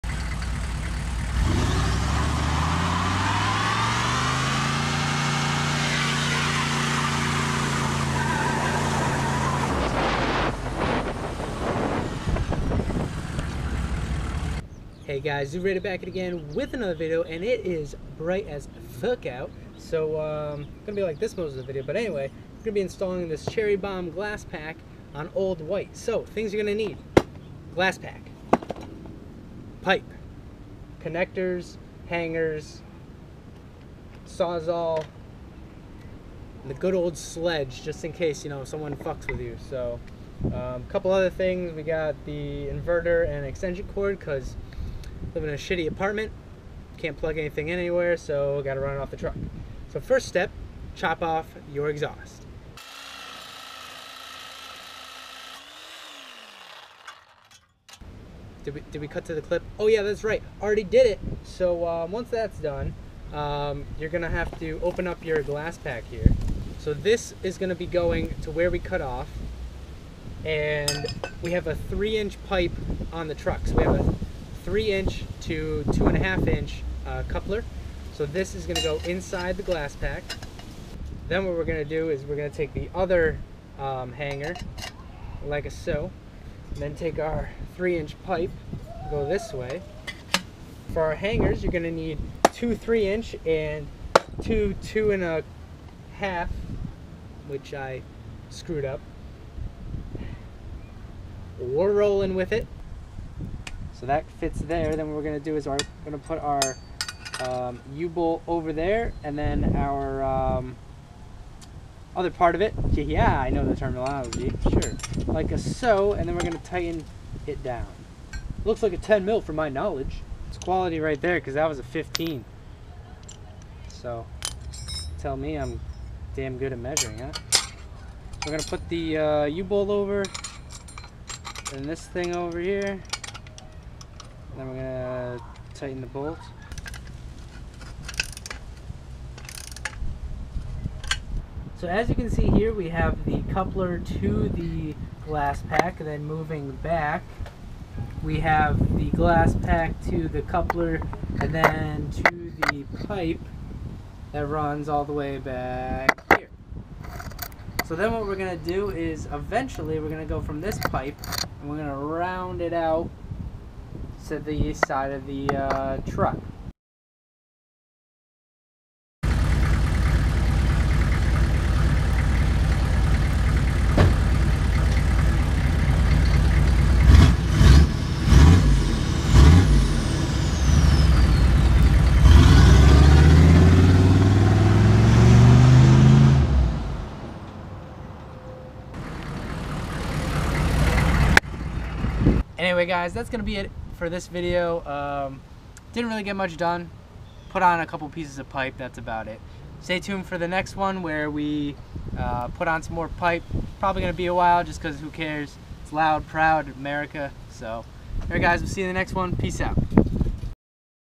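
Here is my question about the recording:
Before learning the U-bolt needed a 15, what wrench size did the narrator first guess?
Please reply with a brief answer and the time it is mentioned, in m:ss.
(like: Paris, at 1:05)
10 mm, at 1:58.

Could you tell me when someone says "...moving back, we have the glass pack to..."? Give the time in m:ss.
2:26.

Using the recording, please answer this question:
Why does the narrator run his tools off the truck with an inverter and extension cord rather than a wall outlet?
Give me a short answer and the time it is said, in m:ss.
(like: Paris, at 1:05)
shitty apartment, at 0:45.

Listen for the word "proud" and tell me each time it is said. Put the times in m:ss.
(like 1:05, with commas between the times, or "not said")
3:26.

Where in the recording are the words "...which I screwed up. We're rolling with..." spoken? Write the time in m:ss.
1:37.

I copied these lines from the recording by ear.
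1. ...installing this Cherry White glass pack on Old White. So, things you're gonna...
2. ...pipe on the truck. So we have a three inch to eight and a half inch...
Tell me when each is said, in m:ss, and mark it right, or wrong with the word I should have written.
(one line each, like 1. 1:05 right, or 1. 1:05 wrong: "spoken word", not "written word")
1. 0:22 wrong: "Bomb", not "White"
2. 1:12 wrong: "two", not "eight".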